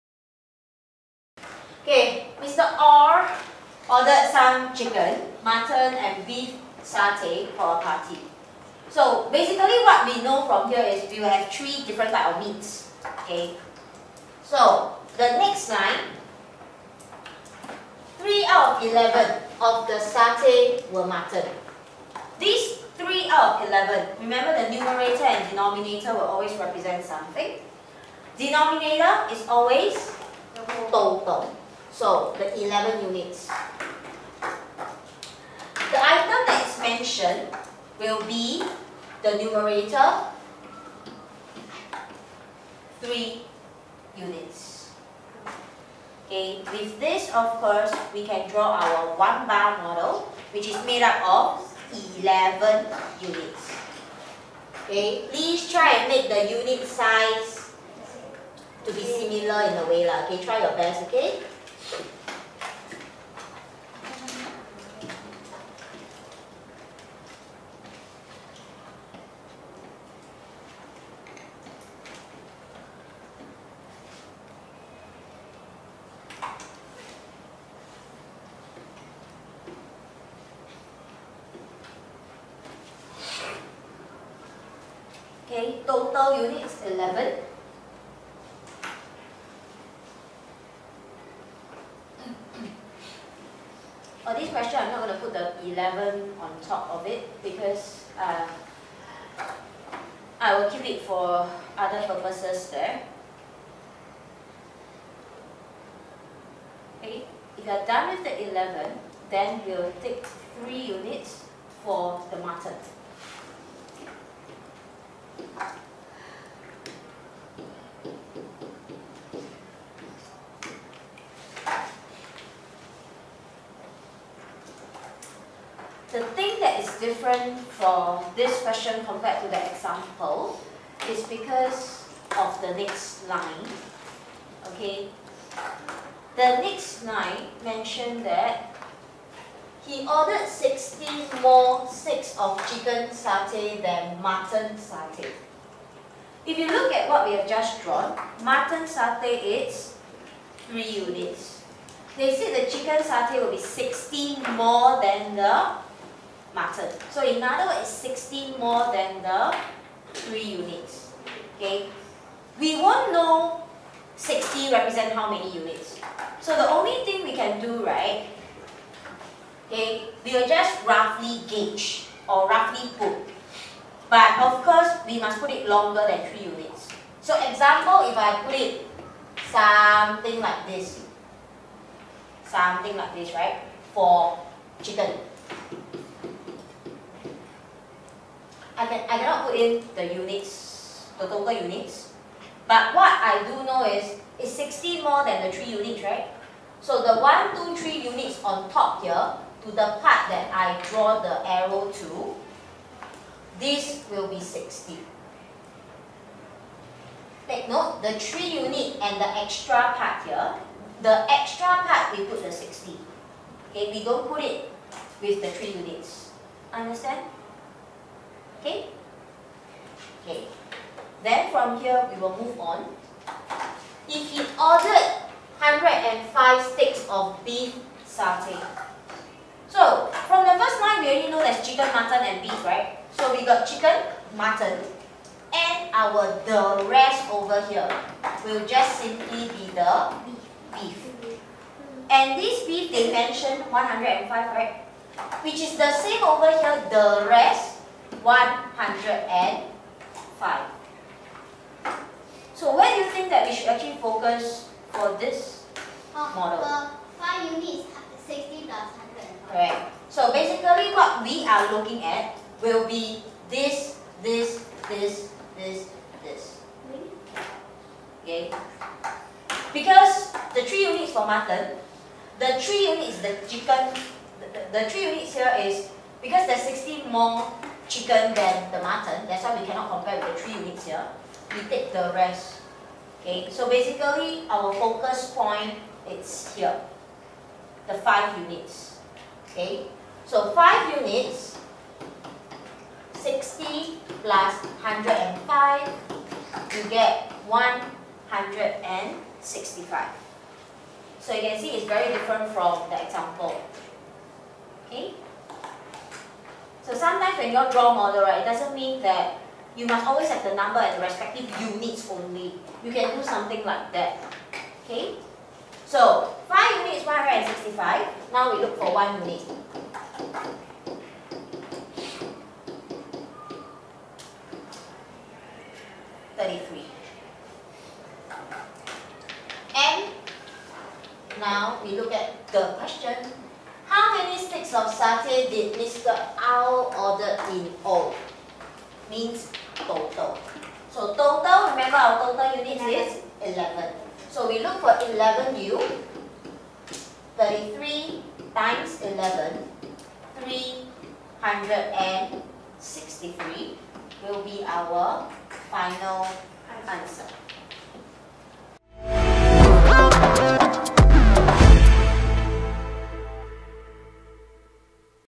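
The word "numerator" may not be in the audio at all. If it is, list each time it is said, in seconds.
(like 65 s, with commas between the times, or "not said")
24 s, 39 s.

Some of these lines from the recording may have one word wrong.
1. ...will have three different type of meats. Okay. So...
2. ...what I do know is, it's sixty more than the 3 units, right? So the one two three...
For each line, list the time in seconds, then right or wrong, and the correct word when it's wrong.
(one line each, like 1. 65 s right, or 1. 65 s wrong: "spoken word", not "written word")
1. 11 s right
2. 192 s right.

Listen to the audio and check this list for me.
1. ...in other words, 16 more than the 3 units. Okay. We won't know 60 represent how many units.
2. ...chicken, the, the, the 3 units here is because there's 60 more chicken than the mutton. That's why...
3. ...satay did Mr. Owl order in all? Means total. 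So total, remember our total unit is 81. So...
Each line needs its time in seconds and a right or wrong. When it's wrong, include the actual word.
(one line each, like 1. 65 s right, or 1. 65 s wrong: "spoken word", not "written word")
1. 157 s right
2. 273 s right
3. 334 s wrong: "11", not "81".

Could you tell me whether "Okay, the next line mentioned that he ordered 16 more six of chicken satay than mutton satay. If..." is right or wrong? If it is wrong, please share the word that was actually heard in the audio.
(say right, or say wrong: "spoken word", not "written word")
right.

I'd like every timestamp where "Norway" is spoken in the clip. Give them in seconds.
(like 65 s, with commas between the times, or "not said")
not said.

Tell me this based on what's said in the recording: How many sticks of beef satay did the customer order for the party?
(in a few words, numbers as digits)
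105.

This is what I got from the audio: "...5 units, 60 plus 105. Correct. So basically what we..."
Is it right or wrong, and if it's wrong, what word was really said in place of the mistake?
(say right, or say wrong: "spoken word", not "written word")
right.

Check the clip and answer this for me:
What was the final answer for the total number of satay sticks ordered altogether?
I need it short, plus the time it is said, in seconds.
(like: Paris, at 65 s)
363, at 350 s.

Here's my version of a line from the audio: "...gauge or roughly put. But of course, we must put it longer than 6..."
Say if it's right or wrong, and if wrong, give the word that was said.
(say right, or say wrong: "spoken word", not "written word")
wrong: "3", not "6".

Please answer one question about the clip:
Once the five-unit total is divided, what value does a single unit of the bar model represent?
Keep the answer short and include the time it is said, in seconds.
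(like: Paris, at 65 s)
33, at 326 s.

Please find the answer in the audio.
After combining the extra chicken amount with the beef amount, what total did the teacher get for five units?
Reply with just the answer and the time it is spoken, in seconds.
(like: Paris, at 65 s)
165, at 296 s.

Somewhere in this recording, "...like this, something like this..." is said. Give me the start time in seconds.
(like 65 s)
180 s.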